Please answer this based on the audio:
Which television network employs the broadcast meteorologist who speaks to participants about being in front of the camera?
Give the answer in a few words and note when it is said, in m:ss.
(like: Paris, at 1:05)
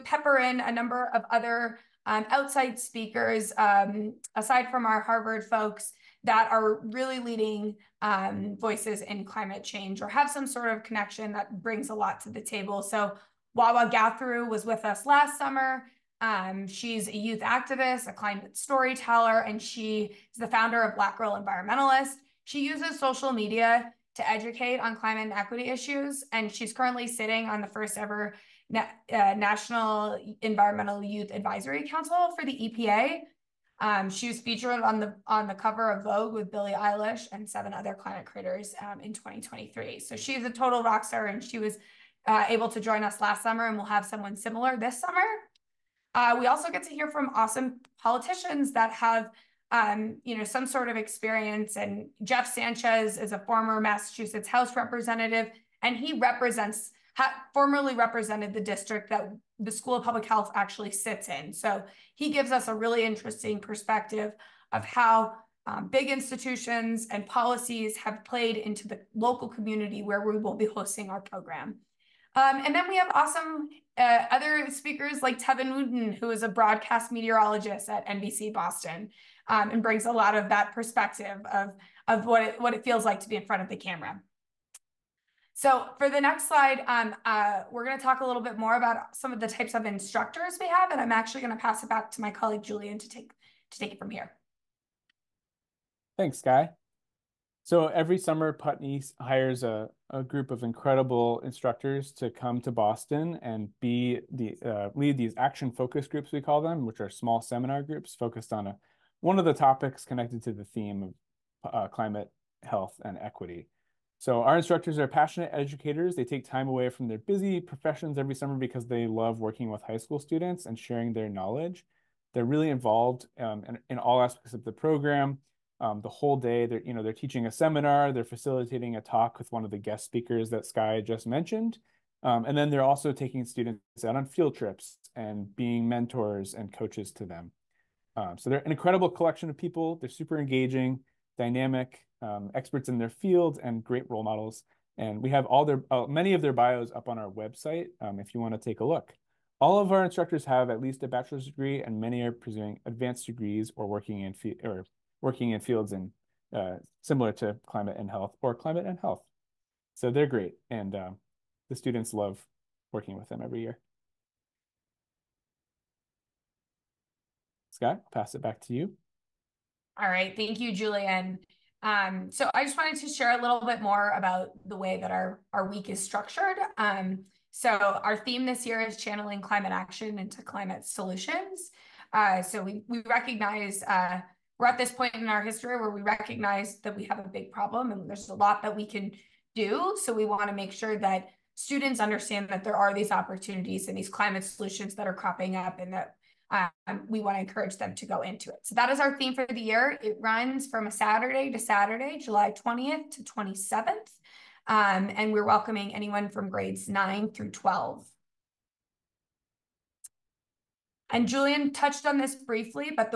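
NBC Boston, at 1:18.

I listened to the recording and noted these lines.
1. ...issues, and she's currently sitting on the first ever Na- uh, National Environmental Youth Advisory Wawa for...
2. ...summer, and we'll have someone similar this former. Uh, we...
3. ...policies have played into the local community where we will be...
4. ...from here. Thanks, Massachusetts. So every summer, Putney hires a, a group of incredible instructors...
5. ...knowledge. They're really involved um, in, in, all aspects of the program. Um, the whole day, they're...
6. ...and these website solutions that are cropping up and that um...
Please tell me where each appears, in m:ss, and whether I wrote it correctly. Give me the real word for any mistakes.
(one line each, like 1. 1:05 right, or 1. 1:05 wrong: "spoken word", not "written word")
1. 0:25 wrong: "Council", not "Wawa"
2. 0:43 wrong: "summer", not "former"
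3. 1:07 right
4. 1:33 wrong: "Sky", not "Massachusetts"
5. 2:01 right
6. 3:13 wrong: "climate", not "website".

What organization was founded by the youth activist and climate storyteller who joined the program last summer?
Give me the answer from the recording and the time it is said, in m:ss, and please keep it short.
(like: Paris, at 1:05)
Black Girl Environmentalist, at 0:20.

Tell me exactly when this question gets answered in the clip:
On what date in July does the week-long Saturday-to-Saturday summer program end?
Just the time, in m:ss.
3:23.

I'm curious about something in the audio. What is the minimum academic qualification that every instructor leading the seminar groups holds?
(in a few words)
Bachelor's degree.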